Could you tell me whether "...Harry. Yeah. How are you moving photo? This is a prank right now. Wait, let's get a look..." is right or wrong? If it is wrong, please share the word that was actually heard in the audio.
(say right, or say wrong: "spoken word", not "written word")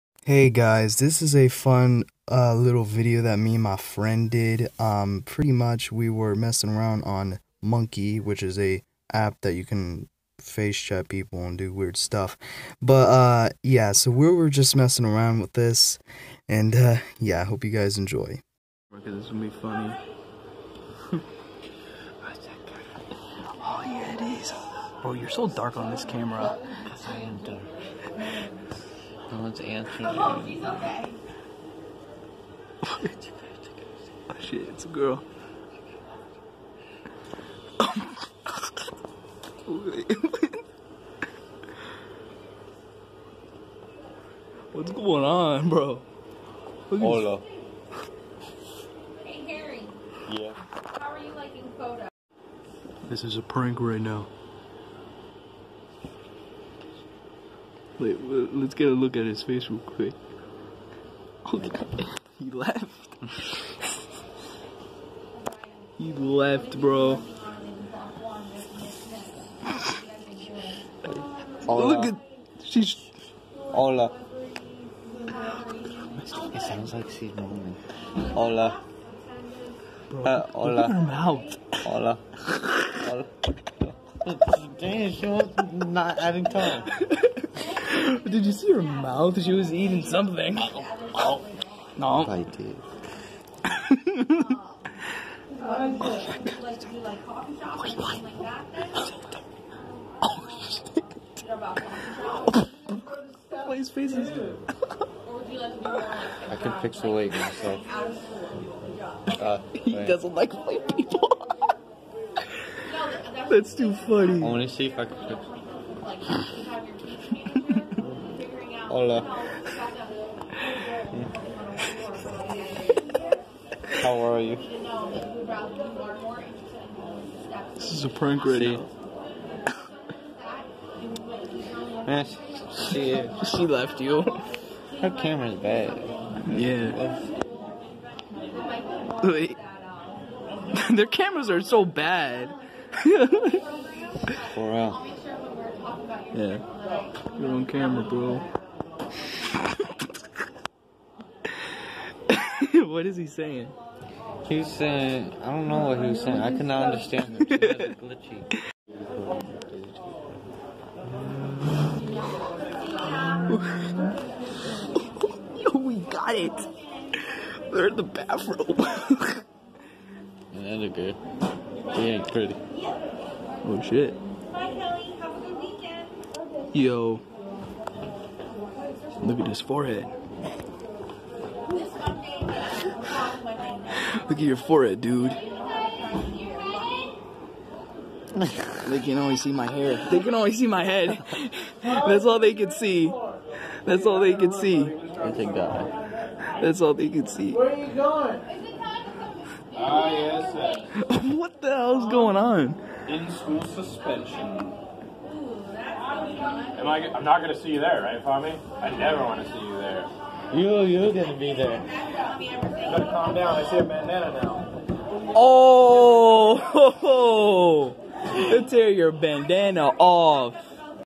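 wrong: "liking", not "moving".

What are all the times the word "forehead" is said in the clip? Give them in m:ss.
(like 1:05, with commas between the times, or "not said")
2:59, 3:04.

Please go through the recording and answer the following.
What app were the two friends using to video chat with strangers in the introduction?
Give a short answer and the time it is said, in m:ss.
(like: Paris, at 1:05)
Monkey, at 0:07.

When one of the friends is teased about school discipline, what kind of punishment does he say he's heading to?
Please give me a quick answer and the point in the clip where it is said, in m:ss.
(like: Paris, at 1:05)
In school suspension, at 3:23.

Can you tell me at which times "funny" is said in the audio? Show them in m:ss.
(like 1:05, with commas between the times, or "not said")
0:19, 1:53.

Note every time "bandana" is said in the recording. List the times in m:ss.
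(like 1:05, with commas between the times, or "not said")
3:33, 3:39.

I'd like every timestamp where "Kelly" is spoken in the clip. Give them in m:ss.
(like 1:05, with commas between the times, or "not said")
2:54.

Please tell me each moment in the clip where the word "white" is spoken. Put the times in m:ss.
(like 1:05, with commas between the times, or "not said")
1:50.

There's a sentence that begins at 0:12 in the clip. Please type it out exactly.
But uh, yeah, so we were just messing around with this, and uh, yeah, I hope you guys enjoy.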